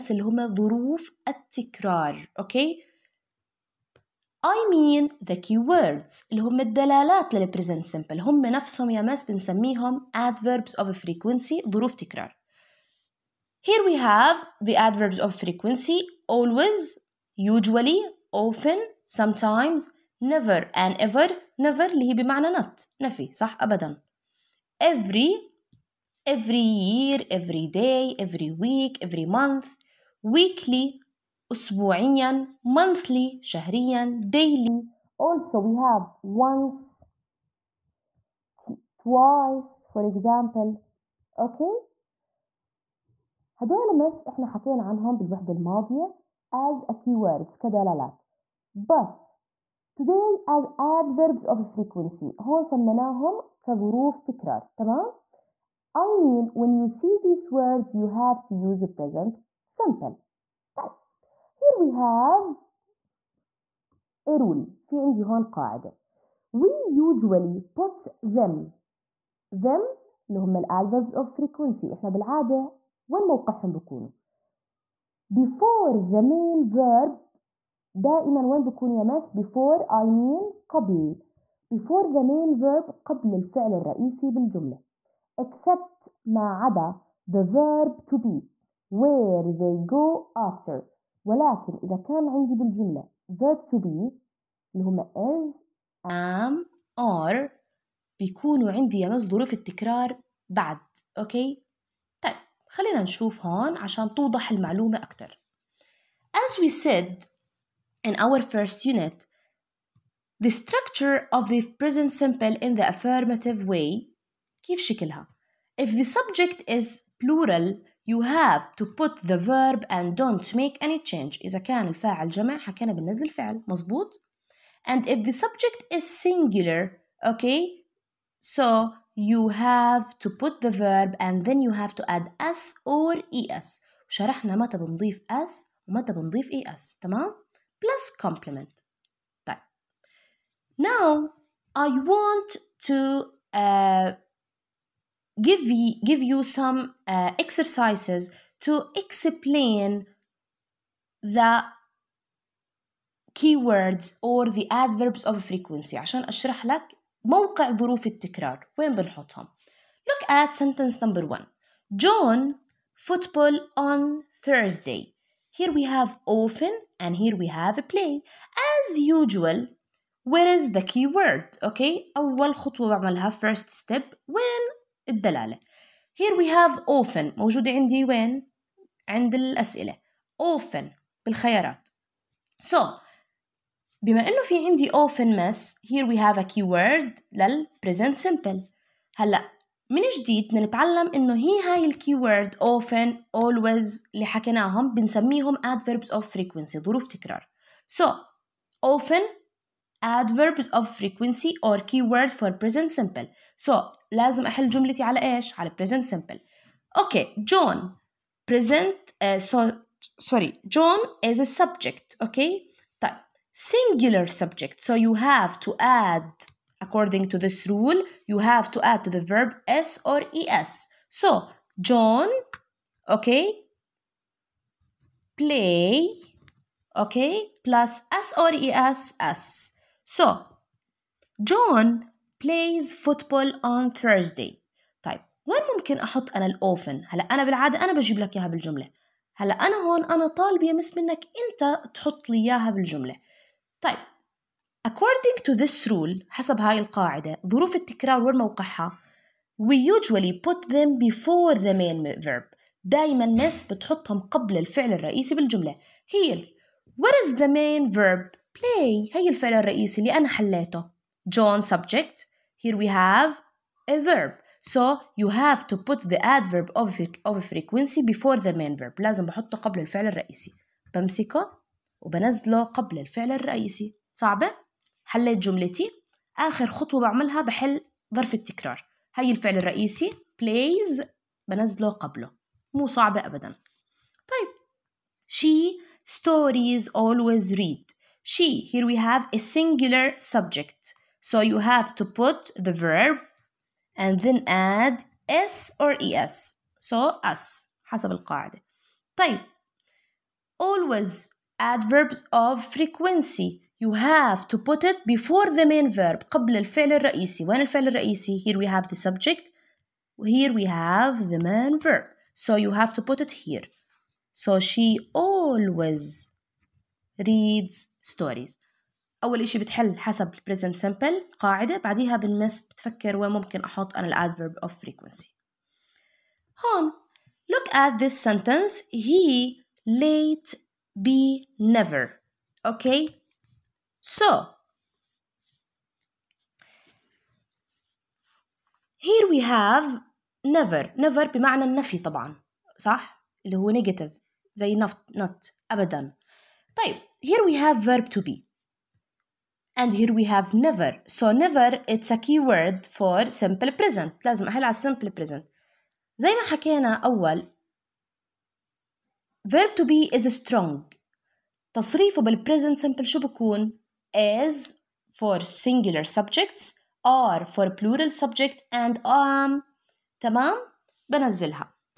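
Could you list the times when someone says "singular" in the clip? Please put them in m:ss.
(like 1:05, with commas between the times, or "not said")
2:06, 3:33, 4:49, 6:05.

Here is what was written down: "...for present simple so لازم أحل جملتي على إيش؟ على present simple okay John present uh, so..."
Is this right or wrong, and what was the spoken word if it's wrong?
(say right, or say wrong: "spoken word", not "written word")
right.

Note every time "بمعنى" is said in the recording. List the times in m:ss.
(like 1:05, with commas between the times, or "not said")
0:22, 5:41.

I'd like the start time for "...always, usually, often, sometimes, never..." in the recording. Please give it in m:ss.
0:16.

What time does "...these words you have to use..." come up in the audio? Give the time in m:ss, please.
0:57.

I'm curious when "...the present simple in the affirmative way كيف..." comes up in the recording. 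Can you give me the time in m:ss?
1:51.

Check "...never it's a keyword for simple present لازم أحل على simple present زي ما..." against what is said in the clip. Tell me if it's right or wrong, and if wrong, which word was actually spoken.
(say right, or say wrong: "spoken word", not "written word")
right.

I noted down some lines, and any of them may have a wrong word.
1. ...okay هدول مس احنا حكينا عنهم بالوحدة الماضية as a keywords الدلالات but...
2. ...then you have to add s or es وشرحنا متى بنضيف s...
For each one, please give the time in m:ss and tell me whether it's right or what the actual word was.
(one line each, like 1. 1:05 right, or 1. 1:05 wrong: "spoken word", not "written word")
1. 0:41 wrong: "كدلالات", not "الدلالات"
2. 2:11 right.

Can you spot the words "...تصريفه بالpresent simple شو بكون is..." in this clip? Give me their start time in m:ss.
6:01.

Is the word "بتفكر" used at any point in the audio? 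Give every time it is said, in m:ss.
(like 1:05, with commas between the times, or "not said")
5:22.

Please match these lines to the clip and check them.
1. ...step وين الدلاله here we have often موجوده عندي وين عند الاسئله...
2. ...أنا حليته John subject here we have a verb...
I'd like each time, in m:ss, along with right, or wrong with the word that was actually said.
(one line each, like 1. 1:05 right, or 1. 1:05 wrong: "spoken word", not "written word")
1. 2:53 right
2. 4:20 right.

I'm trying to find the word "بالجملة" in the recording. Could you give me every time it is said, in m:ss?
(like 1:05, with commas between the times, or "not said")
1:24, 1:32, 3:58, 4:02, 4:15.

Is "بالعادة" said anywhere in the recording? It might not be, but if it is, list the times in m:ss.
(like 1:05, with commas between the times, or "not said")
1:12, 3:57.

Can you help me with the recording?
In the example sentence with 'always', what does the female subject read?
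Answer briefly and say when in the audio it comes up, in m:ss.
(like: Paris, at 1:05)
stories, at 4:46.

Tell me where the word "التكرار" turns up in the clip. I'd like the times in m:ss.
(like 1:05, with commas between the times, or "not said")
0:01, 1:39, 2:38, 4:07, 4:38.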